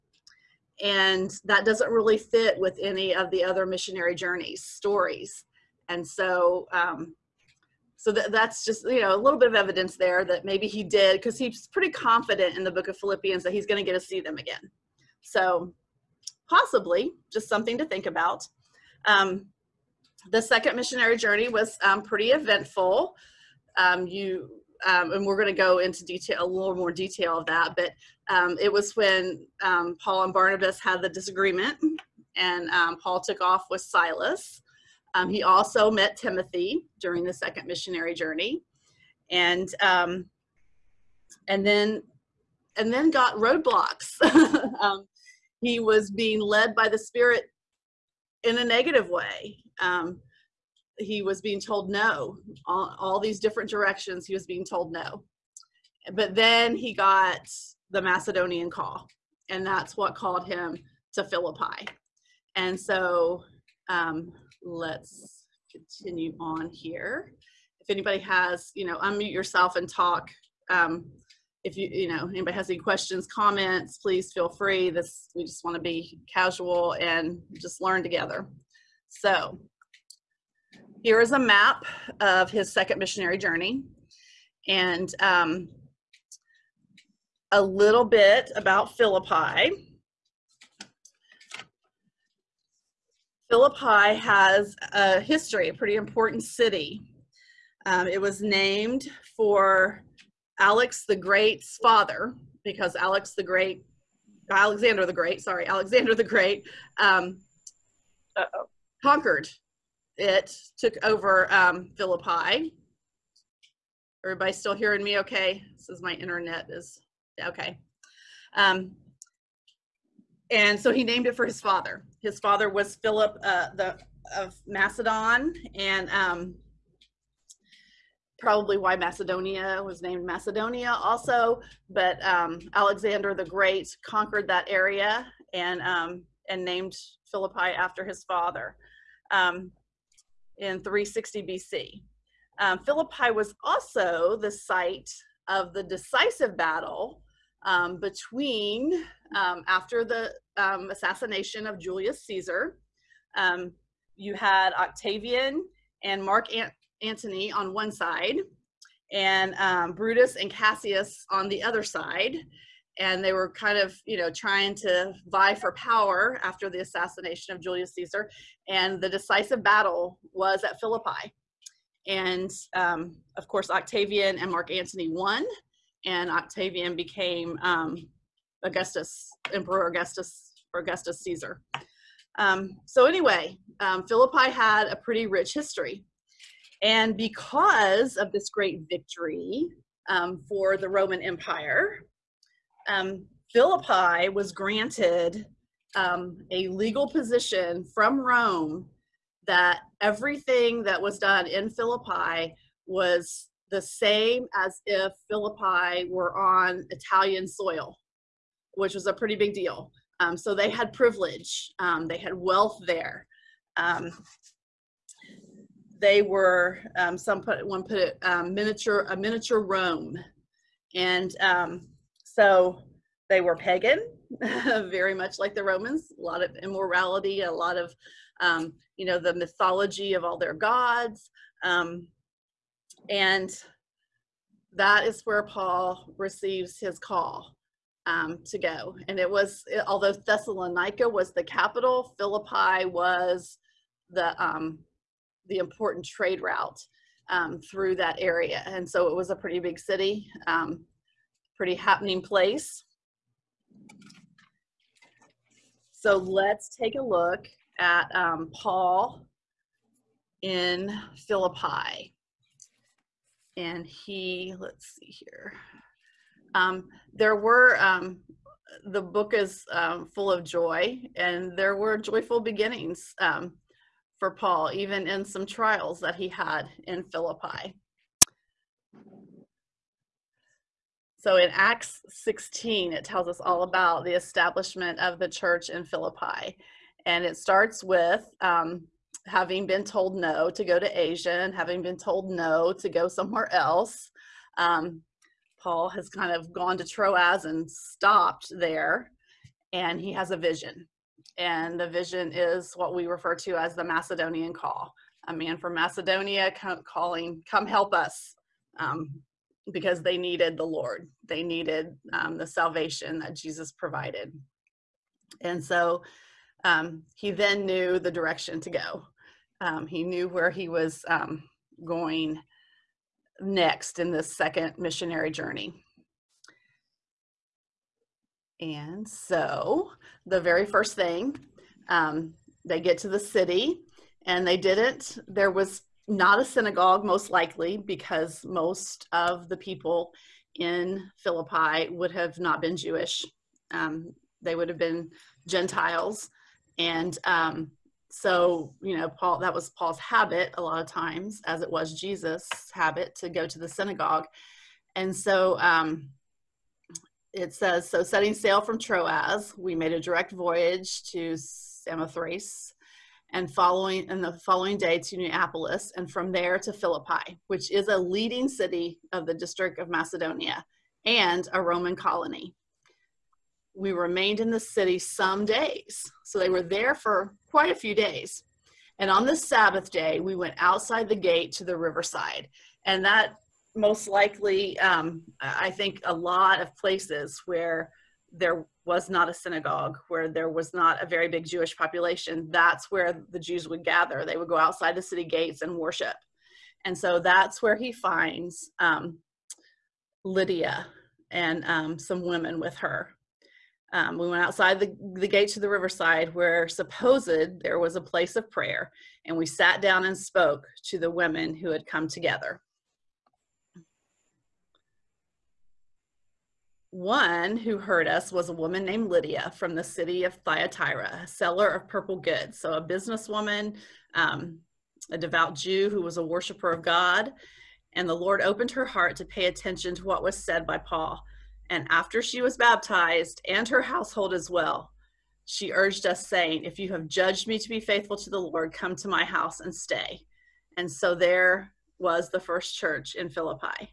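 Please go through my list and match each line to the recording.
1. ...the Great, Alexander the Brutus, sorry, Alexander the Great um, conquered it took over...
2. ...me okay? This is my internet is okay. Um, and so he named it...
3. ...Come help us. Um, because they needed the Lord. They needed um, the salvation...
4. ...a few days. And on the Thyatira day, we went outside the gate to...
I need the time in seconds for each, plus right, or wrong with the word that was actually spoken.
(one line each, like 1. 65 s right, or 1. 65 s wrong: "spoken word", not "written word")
1. 103 s wrong: "Great", not "Brutus"
2. 115 s right
3. 307 s right
4. 377 s wrong: "Sabbath", not "Thyatira".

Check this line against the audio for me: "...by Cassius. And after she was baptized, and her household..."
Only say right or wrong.
wrong.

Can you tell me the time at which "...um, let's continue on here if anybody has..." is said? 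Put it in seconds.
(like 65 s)
63 s.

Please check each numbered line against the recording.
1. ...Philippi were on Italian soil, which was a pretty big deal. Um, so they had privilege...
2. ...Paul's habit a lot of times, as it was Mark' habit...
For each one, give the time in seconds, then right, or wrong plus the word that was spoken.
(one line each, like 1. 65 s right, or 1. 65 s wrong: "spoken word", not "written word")
1. 205 s right
2. 349 s wrong: "Jesus", not "Mark".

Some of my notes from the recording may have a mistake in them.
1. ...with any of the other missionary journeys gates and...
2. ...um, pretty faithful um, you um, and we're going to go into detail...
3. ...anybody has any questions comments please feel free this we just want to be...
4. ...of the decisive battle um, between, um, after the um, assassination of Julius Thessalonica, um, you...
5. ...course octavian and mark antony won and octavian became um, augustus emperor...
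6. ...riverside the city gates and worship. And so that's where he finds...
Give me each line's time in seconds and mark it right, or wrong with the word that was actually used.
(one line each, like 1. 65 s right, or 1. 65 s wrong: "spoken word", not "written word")
1. 2 s wrong: "stories", not "gates"
2. 21 s wrong: "eventful", not "faithful"
3. 72 s right
4. 145 s wrong: "Caesar", not "Thessalonica"
5. 173 s right
6. 394 s wrong: "outside", not "riverside".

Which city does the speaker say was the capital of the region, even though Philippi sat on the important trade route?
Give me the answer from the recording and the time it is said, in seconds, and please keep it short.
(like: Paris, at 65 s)
Thessalonica, at 240 s.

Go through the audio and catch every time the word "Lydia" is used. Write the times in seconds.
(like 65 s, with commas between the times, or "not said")
400 s, 419 s.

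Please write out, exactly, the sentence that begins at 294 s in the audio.
Um, Paul has kind of gone to Troas and stopped there, and he has a vision.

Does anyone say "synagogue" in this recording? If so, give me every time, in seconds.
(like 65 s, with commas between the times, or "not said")
336 s, 353 s, 389 s.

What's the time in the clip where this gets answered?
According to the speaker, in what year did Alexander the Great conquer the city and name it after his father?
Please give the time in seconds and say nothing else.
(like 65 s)
140 s.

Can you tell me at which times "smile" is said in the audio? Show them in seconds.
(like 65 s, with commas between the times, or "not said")
not said.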